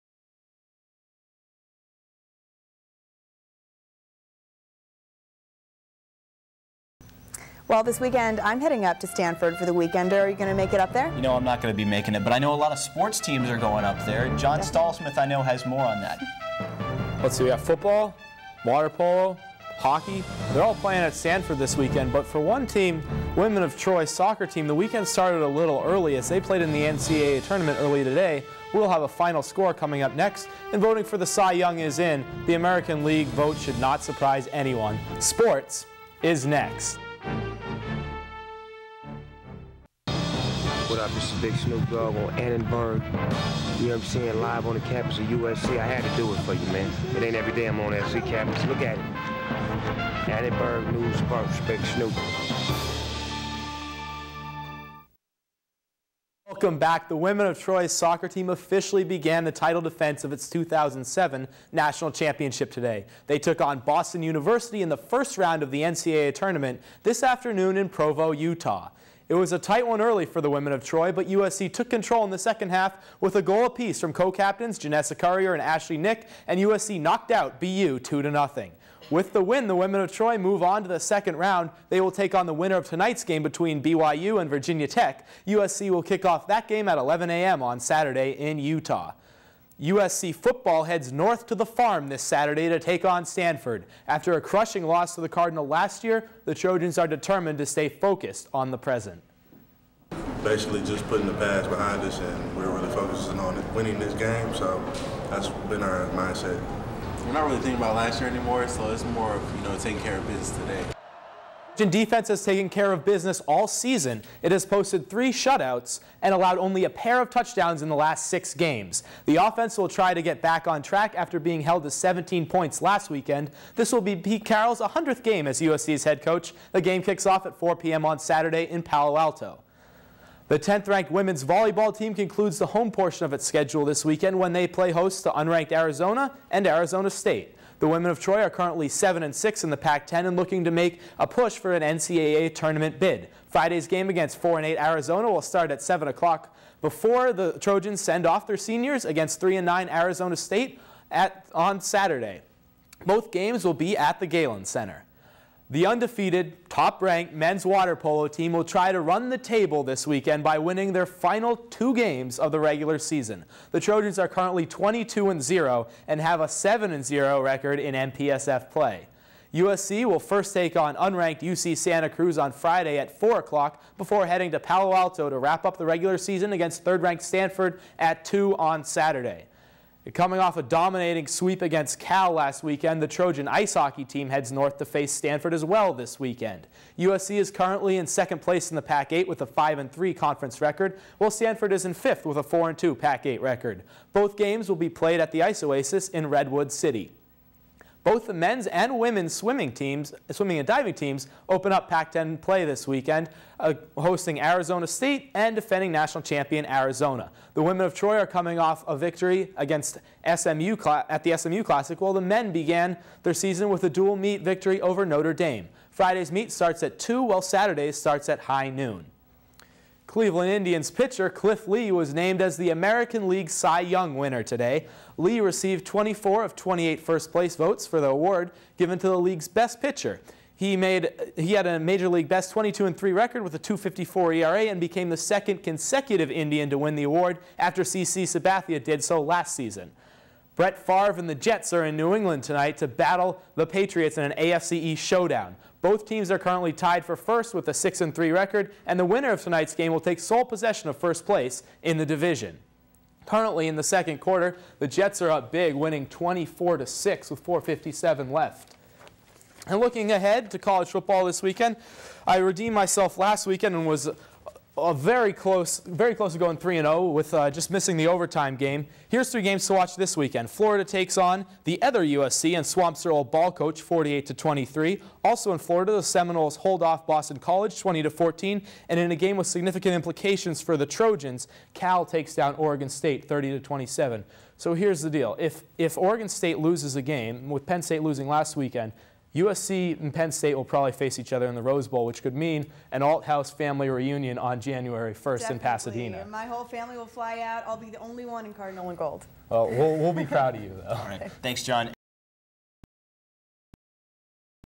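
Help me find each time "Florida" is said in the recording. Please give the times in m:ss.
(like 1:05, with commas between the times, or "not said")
4:30, 4:35.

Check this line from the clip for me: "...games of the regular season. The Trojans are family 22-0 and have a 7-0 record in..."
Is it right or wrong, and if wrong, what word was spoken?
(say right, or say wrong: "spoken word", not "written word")
wrong: "currently", not "family".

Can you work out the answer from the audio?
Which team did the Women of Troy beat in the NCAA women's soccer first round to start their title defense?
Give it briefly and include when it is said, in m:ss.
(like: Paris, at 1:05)
Boston University, at 1:03.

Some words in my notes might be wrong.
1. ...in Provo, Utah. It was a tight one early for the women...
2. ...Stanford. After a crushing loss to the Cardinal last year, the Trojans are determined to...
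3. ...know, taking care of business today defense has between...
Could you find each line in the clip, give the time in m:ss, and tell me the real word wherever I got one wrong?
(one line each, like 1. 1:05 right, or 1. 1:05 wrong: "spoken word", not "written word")
1. 1:07 right
2. 1:33 right
3. 1:49 wrong: "taken", not "between".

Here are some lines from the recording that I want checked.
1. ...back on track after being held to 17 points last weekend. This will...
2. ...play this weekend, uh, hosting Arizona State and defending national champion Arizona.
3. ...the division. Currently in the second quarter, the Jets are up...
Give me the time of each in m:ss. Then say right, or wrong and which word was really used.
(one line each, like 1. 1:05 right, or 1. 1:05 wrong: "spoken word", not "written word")
1. 2:00 right
2. 3:22 right
3. 4:11 right.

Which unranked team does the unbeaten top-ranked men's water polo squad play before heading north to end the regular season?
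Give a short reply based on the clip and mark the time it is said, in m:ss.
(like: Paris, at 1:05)
UC Santa Cruz, at 2:51.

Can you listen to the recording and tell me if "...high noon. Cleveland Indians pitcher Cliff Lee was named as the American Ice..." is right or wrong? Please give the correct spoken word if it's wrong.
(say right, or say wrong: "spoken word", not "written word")
wrong: "League", not "Ice".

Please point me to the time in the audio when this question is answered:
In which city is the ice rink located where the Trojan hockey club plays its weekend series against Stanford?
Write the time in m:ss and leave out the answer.
3:16.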